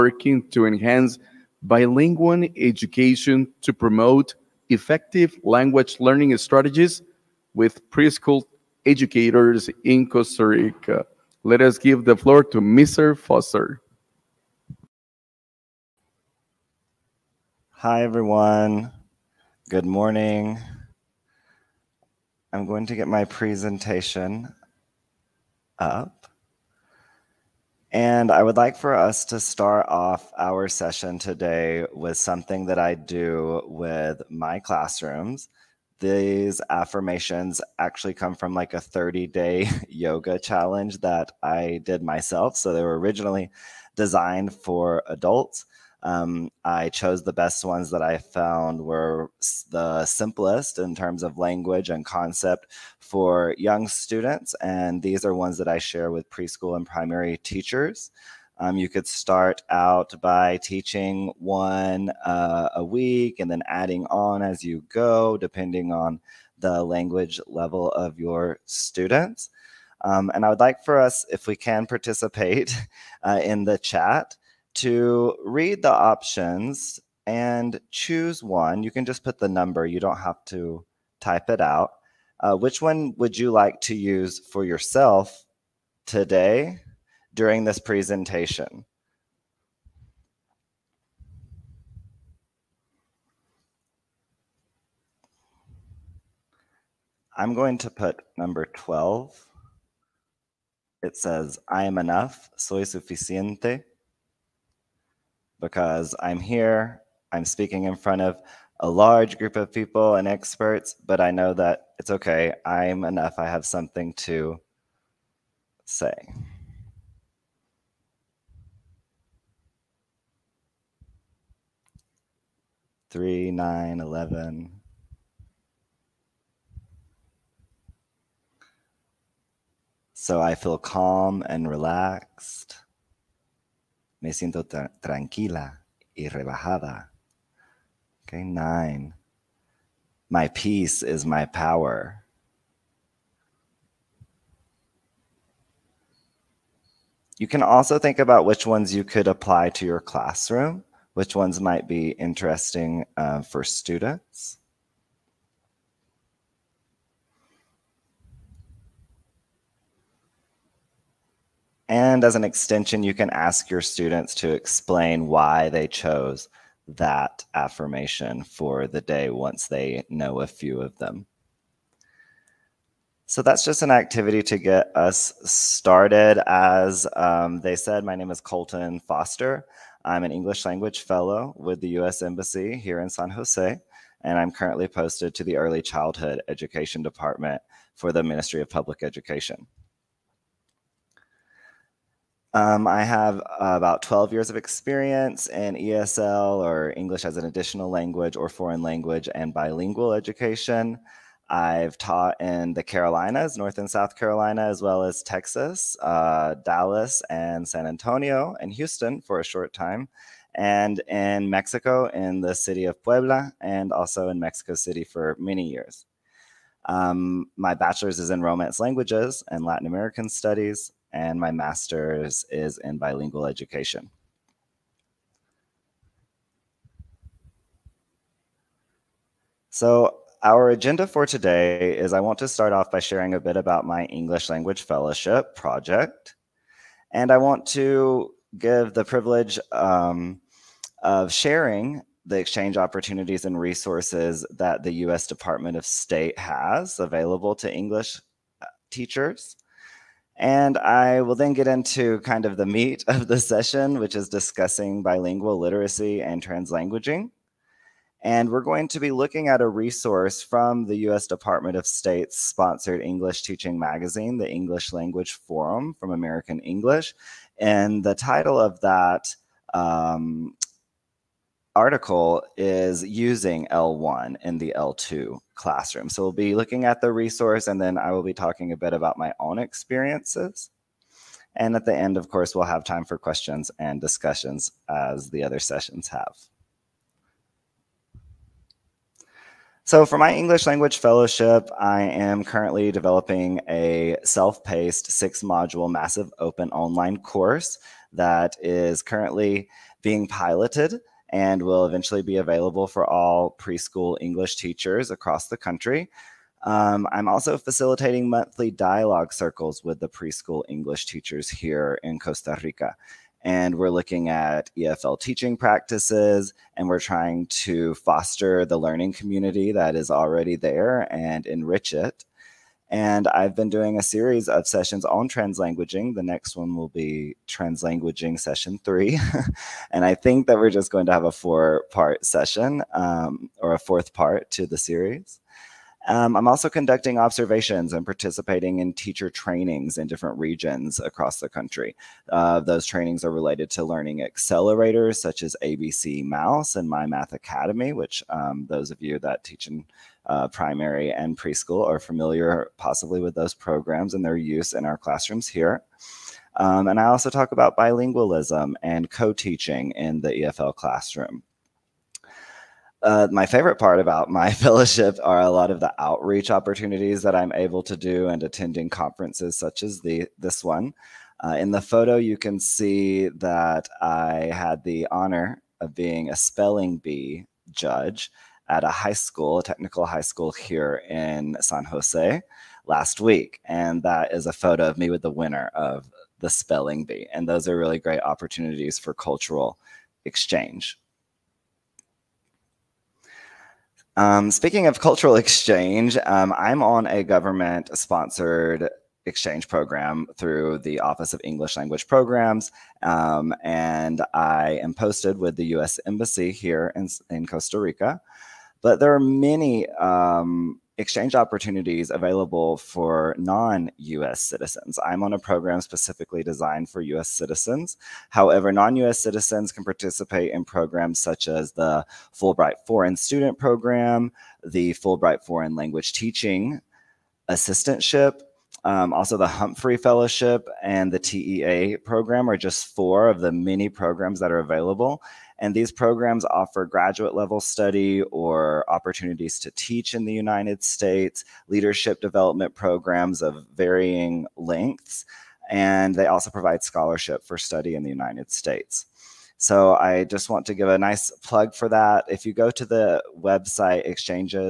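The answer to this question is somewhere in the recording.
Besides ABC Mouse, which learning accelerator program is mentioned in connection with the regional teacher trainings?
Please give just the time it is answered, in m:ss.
5:46.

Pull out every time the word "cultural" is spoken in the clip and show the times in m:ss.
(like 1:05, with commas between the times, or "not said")
6:29, 6:35.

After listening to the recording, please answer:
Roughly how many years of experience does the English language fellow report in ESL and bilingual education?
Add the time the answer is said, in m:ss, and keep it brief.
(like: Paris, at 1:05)
12, at 3:13.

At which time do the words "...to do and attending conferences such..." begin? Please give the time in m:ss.
6:07.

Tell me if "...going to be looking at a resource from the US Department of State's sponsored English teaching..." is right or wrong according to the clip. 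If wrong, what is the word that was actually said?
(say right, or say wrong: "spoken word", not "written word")
right.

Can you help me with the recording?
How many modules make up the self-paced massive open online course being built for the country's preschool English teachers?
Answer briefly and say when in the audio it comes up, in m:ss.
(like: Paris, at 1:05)
6, at 4:55.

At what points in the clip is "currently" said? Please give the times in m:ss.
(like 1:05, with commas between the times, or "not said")
3:04, 4:52, 4:59.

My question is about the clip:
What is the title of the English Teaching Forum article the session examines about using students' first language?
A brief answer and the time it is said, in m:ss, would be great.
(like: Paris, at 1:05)
Using L1 in the L2 classroom, at 4:33.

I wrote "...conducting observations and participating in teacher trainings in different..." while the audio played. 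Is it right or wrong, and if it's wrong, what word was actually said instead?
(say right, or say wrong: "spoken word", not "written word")
right.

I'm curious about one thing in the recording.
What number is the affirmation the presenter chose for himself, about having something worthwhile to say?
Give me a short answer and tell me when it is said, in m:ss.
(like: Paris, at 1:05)
12, at 1:38.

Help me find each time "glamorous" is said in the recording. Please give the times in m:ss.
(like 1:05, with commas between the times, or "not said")
not said.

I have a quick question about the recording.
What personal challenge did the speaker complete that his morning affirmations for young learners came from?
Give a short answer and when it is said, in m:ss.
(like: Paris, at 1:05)
30 day yoga challenge, at 0:38.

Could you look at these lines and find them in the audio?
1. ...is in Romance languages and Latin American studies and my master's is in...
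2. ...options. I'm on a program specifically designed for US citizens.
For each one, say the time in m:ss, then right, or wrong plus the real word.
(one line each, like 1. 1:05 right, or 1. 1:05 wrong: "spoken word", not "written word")
1. 3:38 right
2. 6:54 wrong: "citizens", not "options".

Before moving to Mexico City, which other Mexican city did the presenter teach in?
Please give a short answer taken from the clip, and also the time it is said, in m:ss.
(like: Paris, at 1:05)
Puebla, at 3:33.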